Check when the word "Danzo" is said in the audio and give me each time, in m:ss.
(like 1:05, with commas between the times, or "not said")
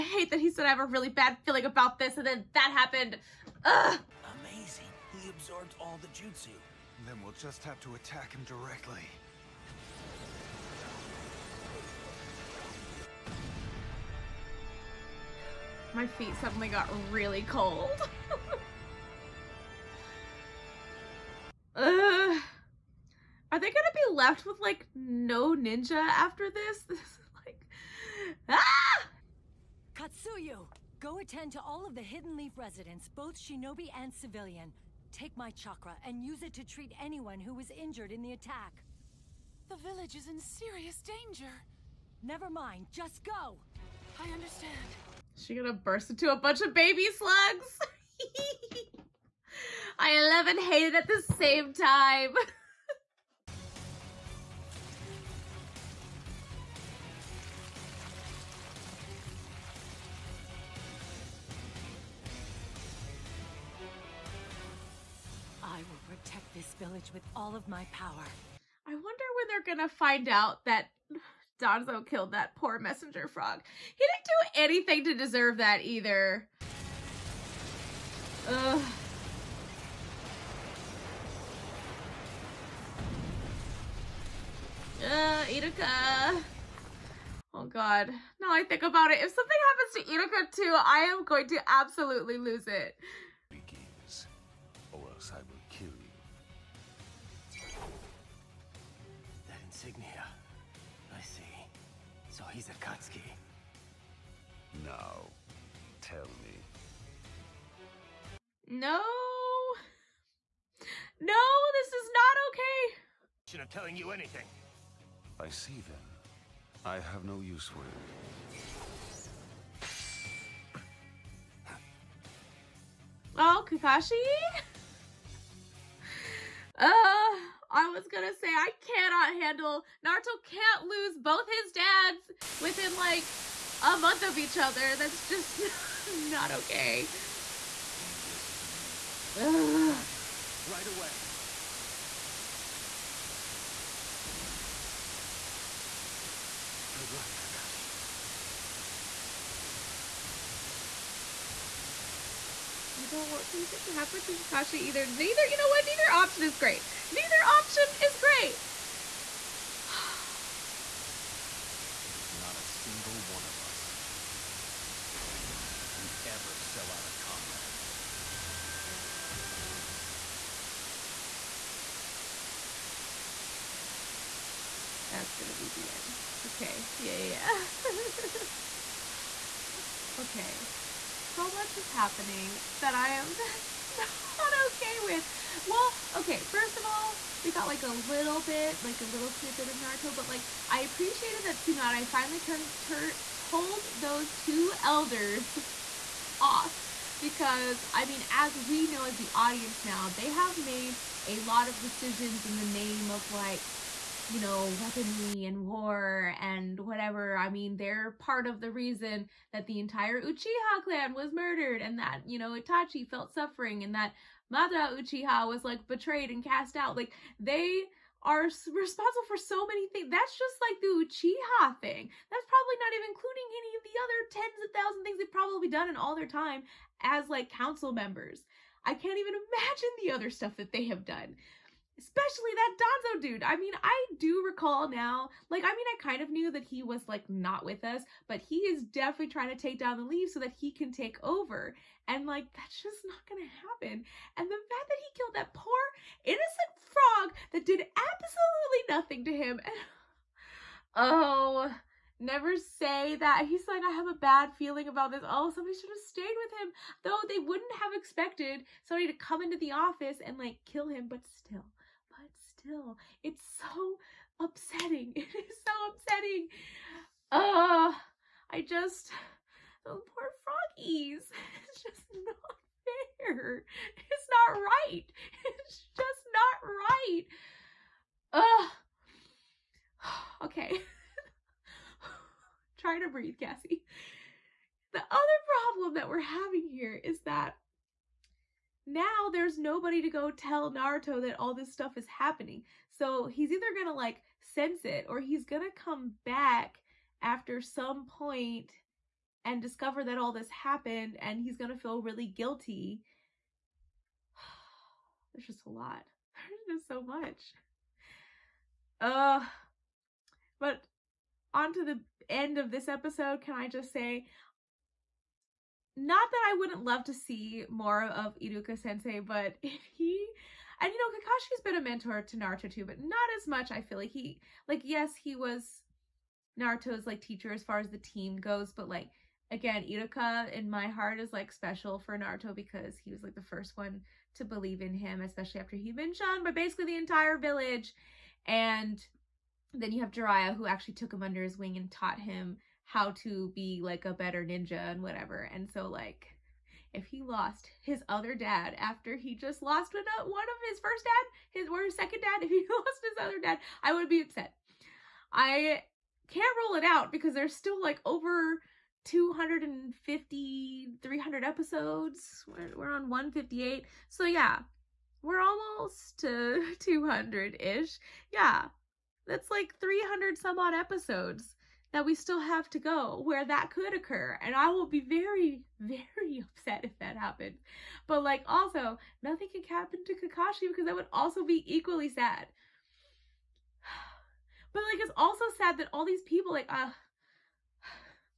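1:11, 3:52.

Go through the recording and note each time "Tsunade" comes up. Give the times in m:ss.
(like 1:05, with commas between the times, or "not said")
3:11.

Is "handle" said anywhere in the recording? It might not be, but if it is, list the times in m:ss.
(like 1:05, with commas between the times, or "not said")
2:09.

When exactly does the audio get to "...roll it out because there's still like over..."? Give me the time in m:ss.
5:56.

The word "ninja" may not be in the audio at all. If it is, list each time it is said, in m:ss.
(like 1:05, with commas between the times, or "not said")
0:25, 5:44.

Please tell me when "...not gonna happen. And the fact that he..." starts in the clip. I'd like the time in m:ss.
4:03.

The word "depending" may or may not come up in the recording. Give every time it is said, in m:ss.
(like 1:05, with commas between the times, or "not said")
not said.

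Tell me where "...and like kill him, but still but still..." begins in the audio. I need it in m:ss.
4:20.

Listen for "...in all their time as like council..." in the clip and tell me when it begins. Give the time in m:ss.
3:45.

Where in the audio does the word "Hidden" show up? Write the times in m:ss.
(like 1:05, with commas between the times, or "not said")
0:32.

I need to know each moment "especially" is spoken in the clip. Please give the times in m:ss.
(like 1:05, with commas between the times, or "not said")
3:52, 5:35.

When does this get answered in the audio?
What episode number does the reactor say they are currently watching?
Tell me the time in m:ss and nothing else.
6:03.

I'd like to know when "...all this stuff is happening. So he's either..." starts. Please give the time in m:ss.
4:51.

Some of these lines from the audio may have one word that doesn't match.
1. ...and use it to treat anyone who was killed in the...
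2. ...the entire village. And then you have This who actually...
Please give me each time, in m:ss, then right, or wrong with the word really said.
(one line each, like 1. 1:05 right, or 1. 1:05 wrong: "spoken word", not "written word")
1. 0:36 wrong: "injured", not "killed"
2. 5:36 wrong: "Jiraiya", not "This".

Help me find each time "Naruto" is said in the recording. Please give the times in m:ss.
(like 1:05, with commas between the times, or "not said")
2:10, 3:09, 4:50, 5:22, 5:26, 5:32.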